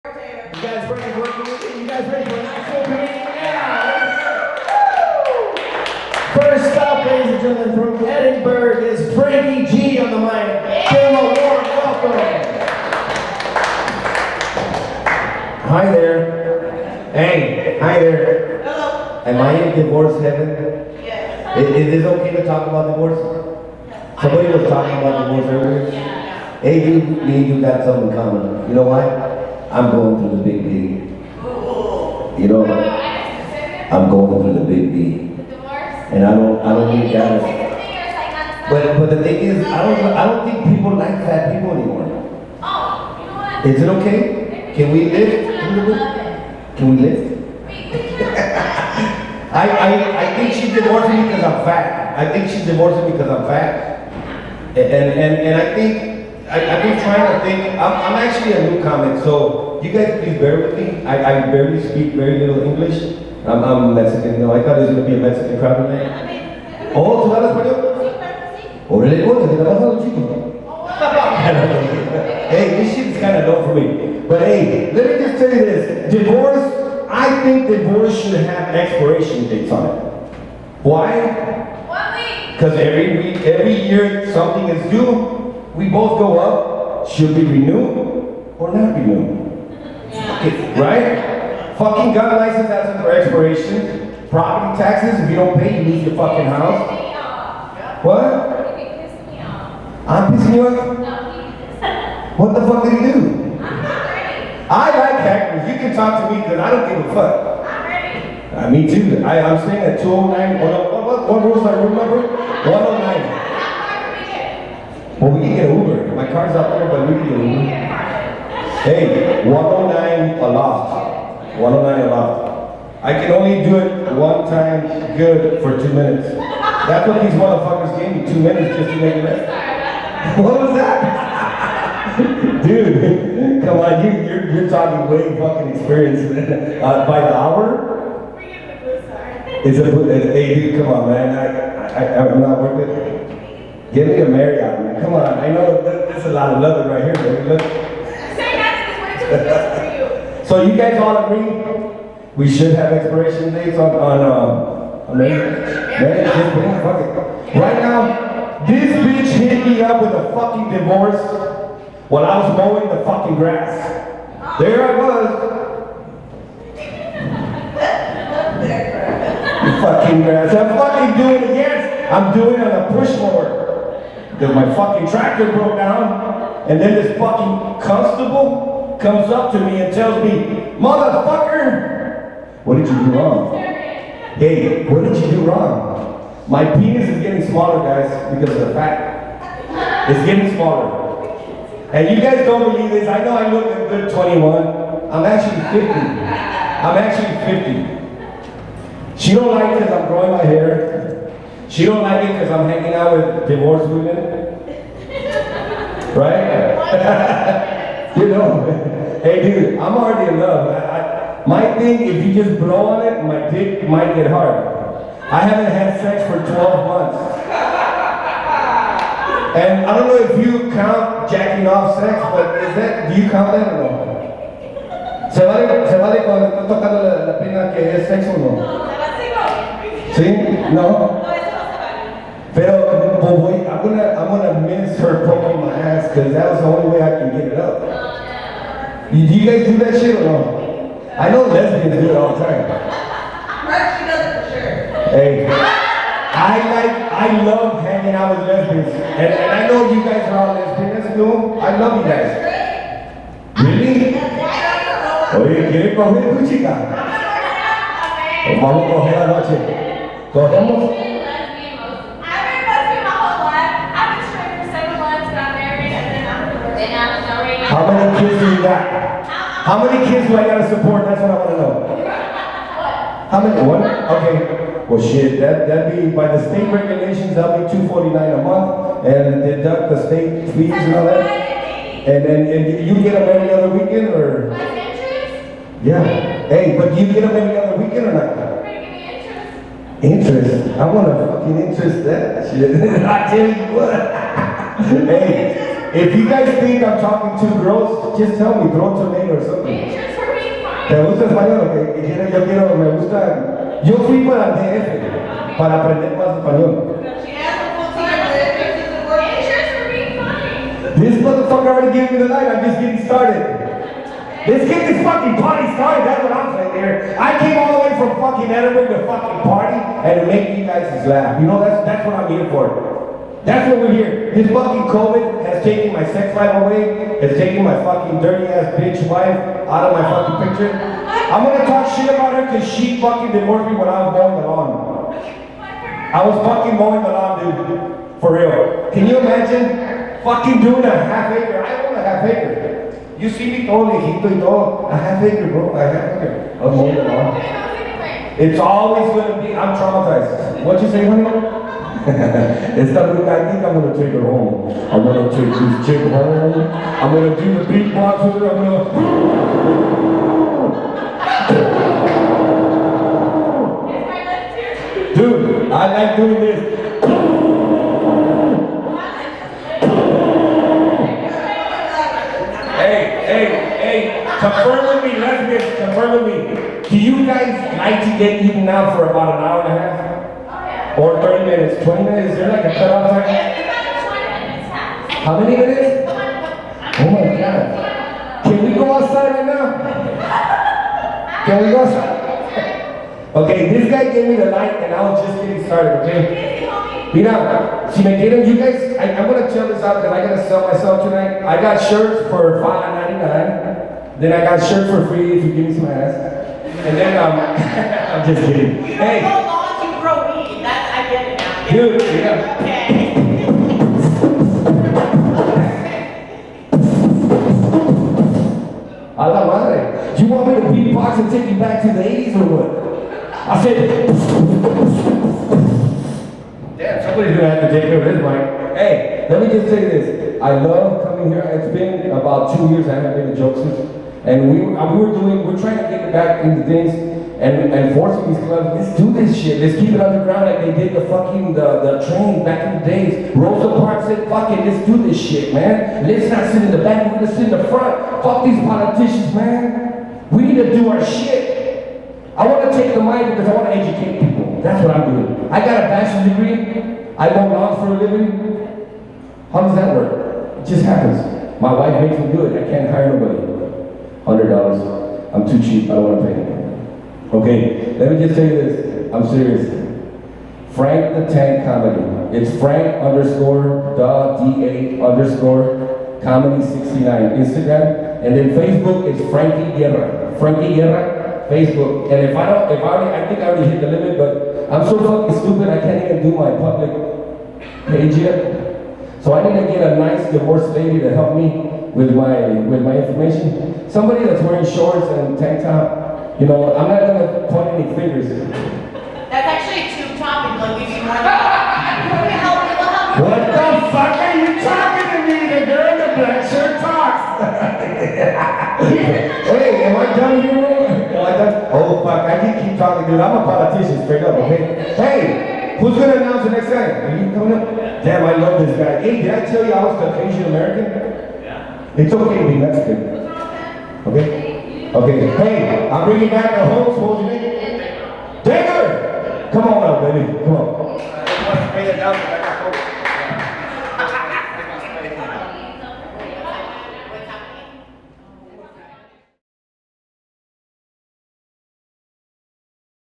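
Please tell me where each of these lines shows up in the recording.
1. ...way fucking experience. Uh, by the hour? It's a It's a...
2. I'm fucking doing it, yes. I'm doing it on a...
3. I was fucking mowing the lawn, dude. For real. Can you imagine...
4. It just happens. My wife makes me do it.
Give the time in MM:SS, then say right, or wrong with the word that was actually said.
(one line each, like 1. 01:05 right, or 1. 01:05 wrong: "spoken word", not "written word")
1. 02:15 right
2. 02:50 right
3. 05:36 right
4. 07:40 right.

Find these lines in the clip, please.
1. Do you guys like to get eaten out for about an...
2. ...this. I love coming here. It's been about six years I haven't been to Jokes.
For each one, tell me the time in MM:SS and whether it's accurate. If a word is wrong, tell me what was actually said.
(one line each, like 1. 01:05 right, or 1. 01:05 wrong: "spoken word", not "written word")
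1. 06:16 right
2. 07:09 wrong: "two", not "six".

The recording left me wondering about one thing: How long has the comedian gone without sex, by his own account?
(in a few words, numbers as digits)
12 months.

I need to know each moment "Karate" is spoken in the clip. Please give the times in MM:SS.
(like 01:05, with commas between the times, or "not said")
not said.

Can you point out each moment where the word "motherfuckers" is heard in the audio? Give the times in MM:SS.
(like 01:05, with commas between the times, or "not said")
02:07, 03:00, 05:11.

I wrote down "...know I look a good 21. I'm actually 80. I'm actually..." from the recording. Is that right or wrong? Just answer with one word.
wrong.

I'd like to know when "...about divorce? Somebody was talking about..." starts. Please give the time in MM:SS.
00:22.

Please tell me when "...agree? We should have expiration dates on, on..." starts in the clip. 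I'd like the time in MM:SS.
02:31.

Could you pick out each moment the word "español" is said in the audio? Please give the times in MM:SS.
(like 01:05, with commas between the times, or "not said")
01:07, 05:01, 05:06.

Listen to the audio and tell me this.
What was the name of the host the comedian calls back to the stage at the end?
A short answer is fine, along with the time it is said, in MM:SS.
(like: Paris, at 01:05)
Digger, at 08:48.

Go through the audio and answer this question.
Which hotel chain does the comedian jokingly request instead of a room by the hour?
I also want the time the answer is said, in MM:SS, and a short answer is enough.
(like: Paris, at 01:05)
Marriott, at 02:24.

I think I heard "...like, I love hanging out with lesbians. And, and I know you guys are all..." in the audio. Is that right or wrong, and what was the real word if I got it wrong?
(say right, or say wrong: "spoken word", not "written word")
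right.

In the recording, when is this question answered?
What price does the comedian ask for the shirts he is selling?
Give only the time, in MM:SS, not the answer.
06:42.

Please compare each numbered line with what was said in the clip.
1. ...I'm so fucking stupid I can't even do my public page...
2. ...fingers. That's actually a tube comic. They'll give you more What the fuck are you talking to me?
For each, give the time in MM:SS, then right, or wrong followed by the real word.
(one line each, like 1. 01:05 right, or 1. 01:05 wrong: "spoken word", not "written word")
1. 08:04 right
2. 08:17 wrong: "topic", not "comic".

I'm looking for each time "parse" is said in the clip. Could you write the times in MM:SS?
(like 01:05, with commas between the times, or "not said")
not said.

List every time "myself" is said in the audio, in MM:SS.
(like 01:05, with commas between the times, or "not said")
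06:40.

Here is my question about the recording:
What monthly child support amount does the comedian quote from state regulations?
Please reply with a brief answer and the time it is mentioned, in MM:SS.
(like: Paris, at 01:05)
249, at 04:37.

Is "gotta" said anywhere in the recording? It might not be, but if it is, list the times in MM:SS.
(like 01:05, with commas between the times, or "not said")
04:30, 06:40.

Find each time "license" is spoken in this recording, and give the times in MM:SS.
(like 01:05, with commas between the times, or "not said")
01:32.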